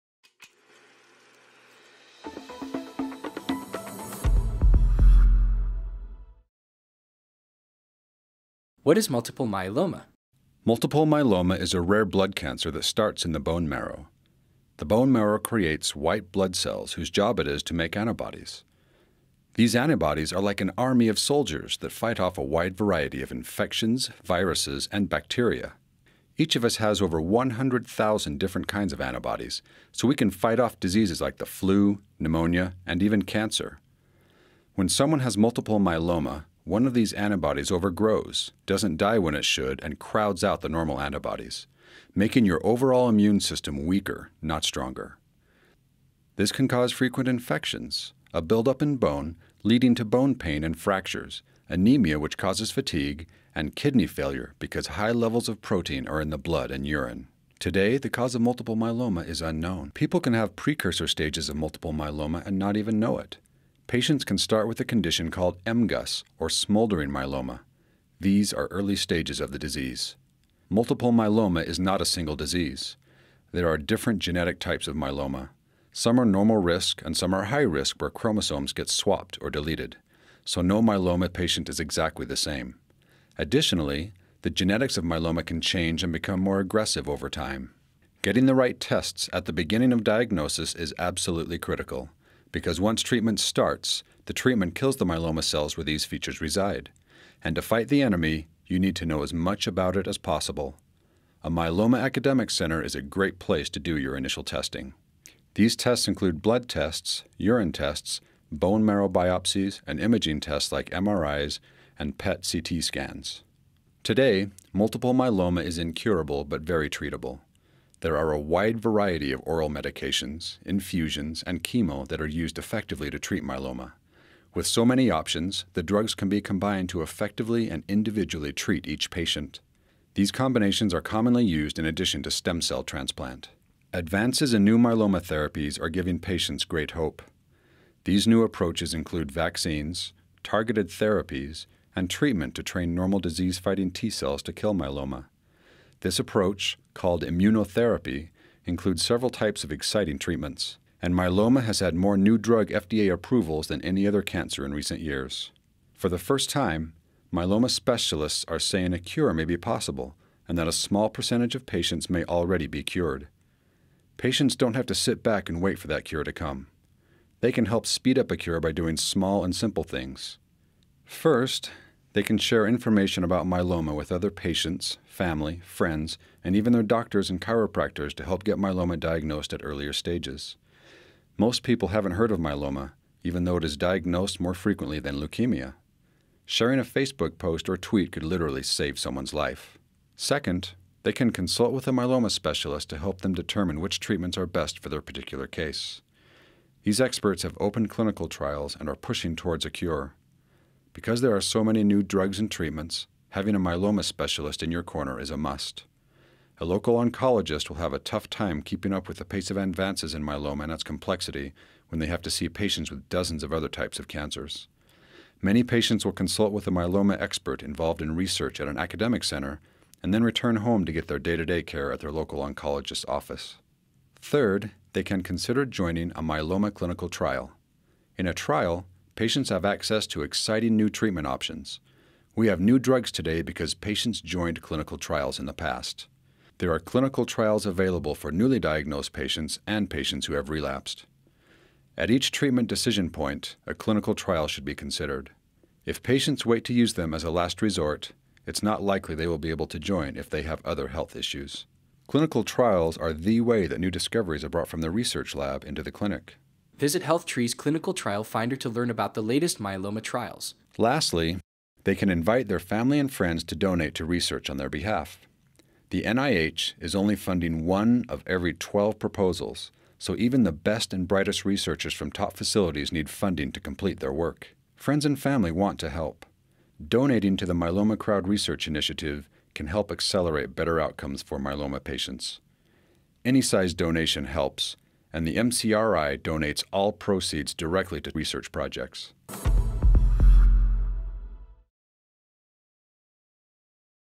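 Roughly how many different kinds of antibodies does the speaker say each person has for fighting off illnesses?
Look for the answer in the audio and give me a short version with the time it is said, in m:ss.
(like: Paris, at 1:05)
over 100,000, at 0:27.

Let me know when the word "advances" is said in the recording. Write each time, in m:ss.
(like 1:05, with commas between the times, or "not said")
2:13, 3:29.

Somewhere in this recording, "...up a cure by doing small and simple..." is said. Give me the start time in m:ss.
2:48.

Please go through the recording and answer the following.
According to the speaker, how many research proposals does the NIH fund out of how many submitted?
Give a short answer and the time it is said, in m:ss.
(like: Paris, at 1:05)
1 of every 12, at 4:27.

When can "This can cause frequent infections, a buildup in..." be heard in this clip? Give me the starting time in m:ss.
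0:46.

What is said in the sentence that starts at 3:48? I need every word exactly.
In a trial, patients have access to exciting new treatment options.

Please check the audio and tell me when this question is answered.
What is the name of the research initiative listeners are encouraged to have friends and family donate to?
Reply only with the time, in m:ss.
4:37.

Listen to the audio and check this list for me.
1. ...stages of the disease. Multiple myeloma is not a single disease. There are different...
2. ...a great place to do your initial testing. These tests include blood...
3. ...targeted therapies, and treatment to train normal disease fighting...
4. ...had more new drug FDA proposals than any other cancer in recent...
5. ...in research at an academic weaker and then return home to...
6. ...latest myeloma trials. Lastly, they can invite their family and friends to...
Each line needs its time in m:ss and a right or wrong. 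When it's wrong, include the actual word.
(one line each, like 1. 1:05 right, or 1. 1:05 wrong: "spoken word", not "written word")
1. 1:08 right
2. 1:42 right
3. 2:20 right
4. 2:31 wrong: "approvals", not "proposals"
5. 3:38 wrong: "center", not "weaker"
6. 4:19 right.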